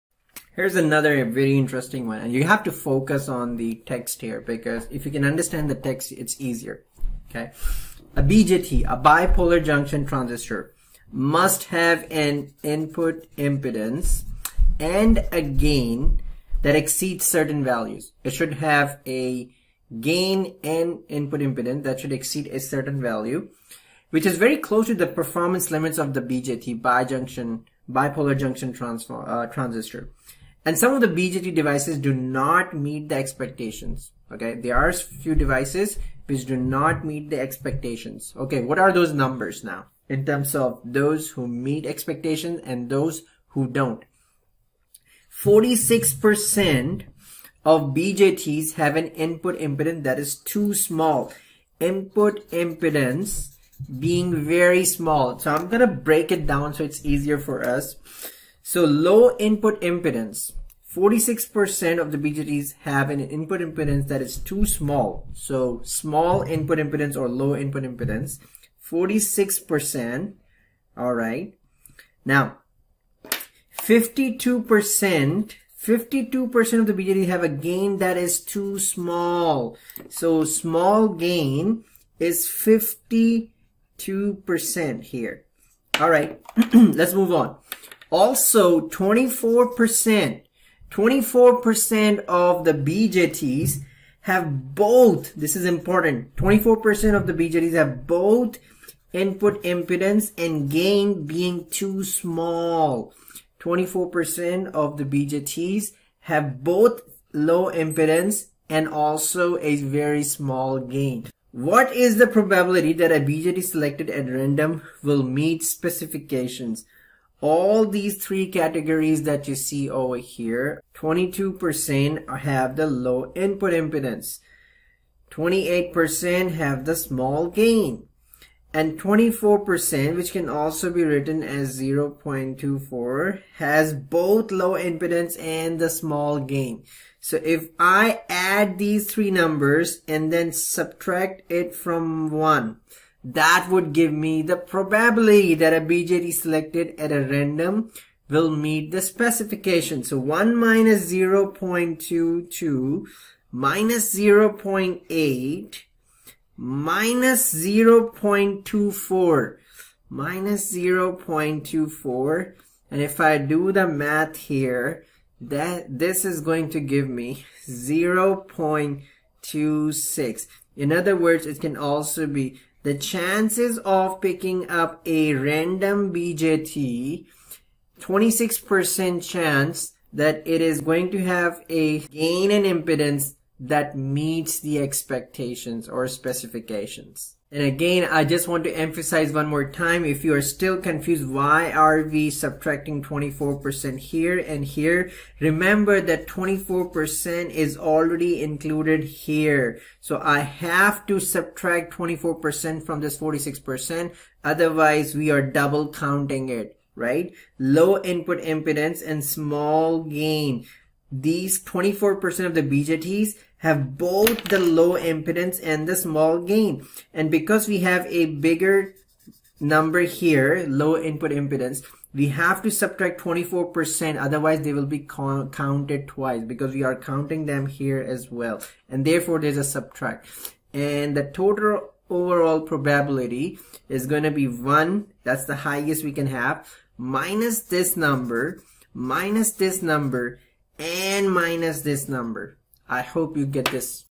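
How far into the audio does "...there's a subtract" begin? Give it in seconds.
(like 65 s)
229 s.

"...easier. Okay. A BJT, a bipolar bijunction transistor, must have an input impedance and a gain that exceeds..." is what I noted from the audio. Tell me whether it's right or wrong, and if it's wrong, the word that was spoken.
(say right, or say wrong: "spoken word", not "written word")
wrong: "junction", not "bijunction".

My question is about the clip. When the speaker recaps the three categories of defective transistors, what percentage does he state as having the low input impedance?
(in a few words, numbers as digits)
22%.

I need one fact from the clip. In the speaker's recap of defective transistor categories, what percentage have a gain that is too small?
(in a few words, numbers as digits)
28%.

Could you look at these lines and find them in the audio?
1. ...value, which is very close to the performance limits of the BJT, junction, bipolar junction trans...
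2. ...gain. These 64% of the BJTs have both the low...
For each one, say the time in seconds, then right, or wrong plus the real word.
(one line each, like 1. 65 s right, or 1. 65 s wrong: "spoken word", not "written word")
1. 23 s wrong: "bijunction", not "junction"
2. 210 s wrong: "24", not "64".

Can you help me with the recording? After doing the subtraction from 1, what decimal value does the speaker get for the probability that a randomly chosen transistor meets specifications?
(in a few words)
0.26.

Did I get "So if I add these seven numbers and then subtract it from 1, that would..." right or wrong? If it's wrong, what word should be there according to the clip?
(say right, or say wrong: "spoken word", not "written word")
wrong: "three", not "seven".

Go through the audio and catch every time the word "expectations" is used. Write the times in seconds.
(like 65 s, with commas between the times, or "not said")
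33 s, 37 s, 41 s, 184 s.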